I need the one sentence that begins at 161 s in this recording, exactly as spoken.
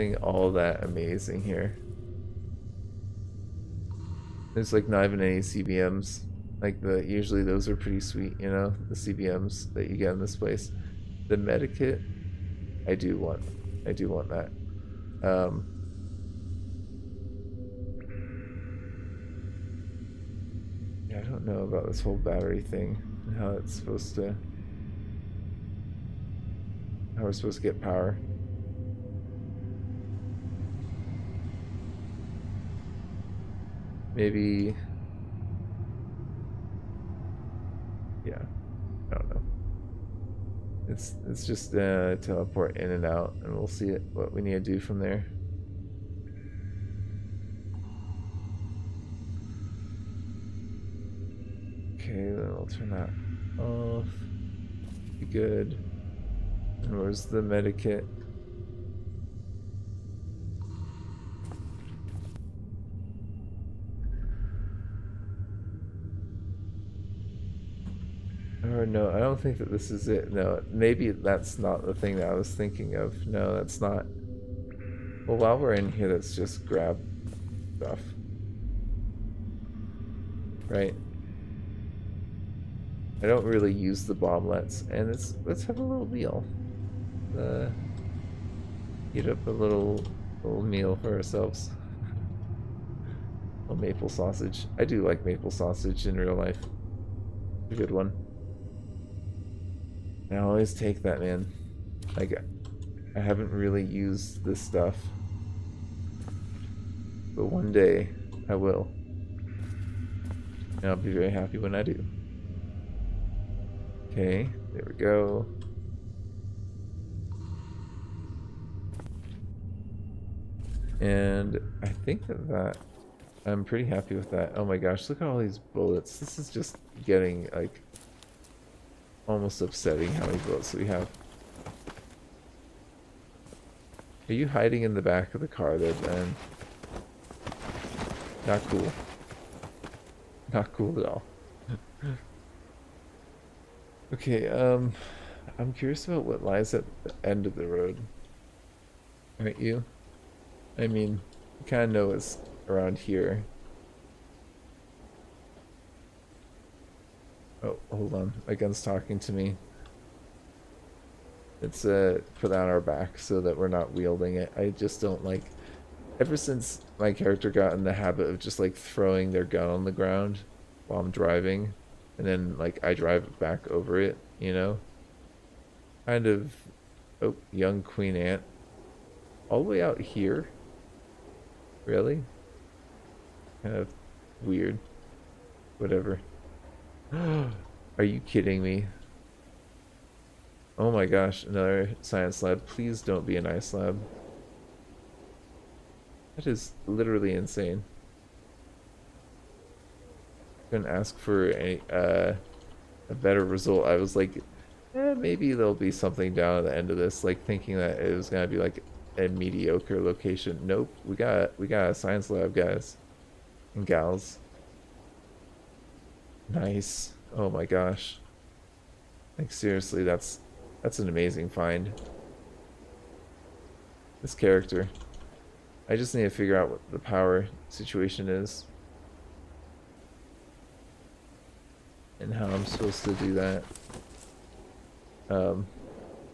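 It's uh, put on our back so that we're not wielding it.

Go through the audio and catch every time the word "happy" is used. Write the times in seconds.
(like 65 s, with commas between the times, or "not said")
111 s, 123 s.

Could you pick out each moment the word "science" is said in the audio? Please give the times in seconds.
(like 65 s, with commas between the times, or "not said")
192 s, 211 s.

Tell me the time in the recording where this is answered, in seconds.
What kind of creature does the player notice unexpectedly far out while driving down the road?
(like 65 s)
177 s.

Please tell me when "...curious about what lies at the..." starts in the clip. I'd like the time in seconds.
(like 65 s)
145 s.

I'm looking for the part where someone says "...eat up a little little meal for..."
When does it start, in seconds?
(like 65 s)
89 s.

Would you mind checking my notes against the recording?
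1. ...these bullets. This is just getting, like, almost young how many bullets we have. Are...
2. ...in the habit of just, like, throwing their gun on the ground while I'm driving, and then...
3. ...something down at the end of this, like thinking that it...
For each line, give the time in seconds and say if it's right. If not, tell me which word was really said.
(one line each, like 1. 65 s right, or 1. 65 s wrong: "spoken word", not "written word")
1. 125 s wrong: "upsetting", not "young"
2. 167 s right
3. 205 s right.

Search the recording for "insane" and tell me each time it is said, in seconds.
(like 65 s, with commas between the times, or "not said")
197 s.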